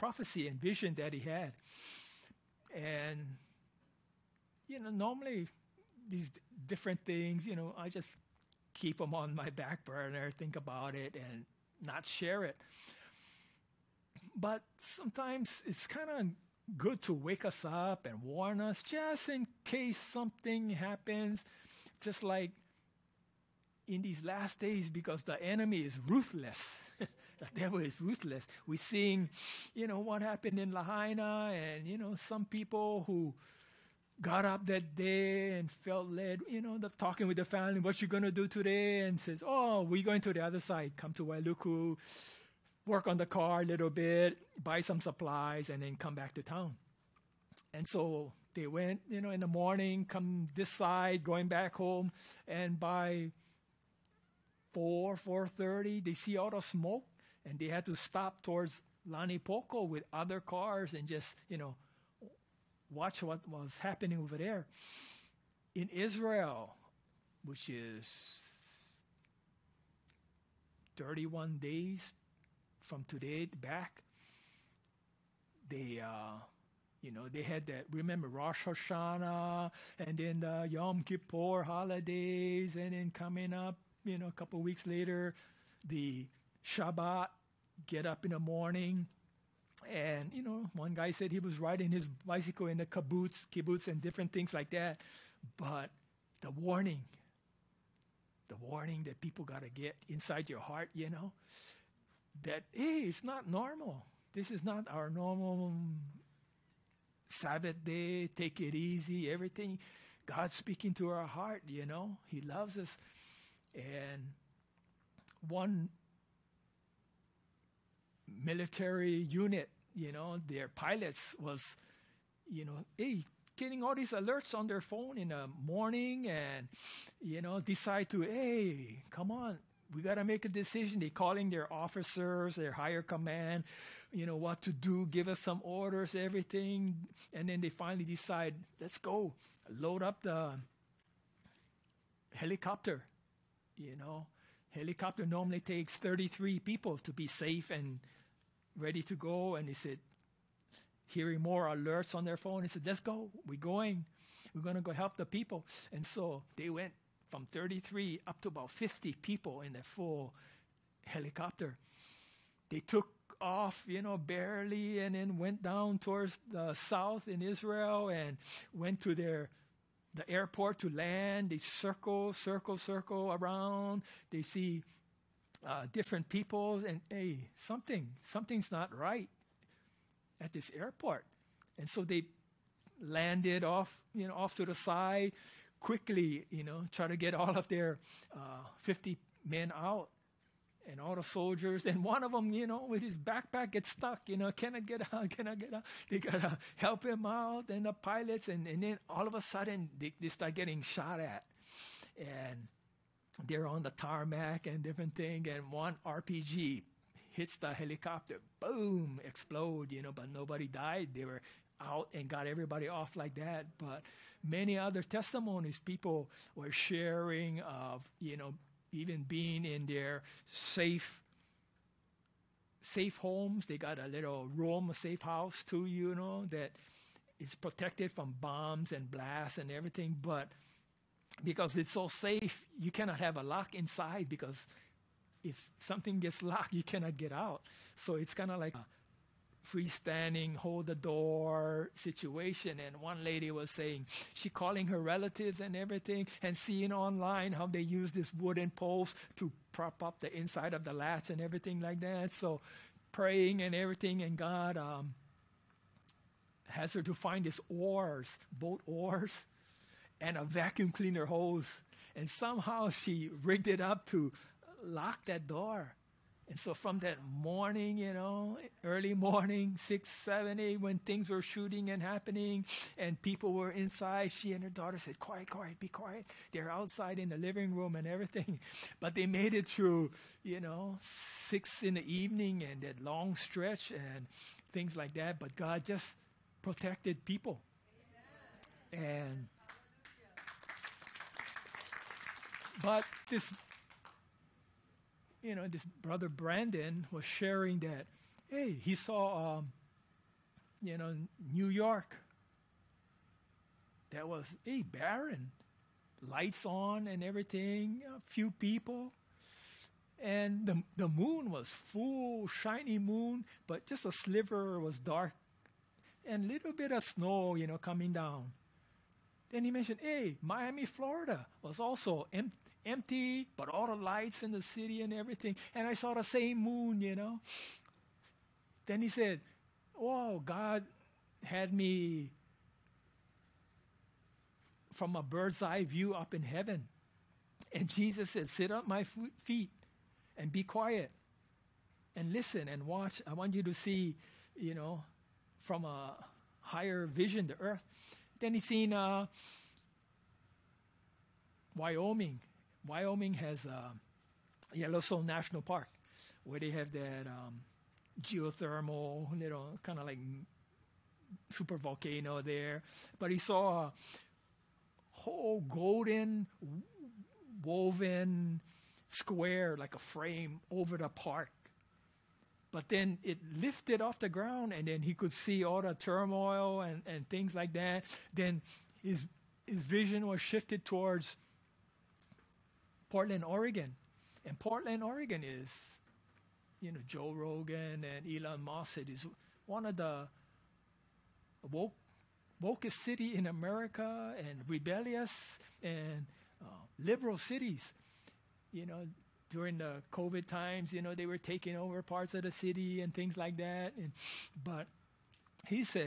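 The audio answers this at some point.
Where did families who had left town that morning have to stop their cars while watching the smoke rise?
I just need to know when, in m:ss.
0:59.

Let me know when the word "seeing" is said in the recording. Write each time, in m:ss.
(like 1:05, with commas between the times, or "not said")
0:28, 4:06.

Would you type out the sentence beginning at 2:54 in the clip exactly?
They see uh, different people, and hey, something, something's not right at this airport.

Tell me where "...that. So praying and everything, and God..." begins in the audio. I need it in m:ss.
4:11.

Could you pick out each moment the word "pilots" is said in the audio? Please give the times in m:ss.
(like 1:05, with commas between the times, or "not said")
2:00, 3:17.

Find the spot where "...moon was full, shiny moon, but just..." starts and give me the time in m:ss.
5:11.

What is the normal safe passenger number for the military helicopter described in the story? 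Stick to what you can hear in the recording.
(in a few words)
33.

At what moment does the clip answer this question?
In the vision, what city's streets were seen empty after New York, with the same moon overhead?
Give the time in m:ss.
5:20.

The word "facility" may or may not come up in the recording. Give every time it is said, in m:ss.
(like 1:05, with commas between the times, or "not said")
not said.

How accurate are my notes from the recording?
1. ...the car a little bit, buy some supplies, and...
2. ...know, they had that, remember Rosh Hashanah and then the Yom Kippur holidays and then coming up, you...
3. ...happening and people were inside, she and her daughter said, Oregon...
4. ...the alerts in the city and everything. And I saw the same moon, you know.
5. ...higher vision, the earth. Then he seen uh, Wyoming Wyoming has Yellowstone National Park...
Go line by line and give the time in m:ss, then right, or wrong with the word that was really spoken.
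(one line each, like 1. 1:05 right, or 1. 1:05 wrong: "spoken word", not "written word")
1. 0:43 right
2. 1:17 right
3. 4:31 wrong: "Quiet", not "Oregon"
4. 5:23 wrong: "lights", not "alerts"
5. 5:46 right.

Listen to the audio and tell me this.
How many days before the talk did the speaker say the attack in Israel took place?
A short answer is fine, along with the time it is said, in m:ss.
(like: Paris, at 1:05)
31, at 1:10.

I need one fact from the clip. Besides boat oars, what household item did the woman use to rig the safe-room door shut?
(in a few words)
vacuum cleaner hose.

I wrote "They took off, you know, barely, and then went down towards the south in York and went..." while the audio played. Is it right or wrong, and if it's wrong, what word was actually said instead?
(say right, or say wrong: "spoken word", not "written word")
wrong: "Israel", not "York".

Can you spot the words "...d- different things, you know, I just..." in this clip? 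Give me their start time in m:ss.
0:06.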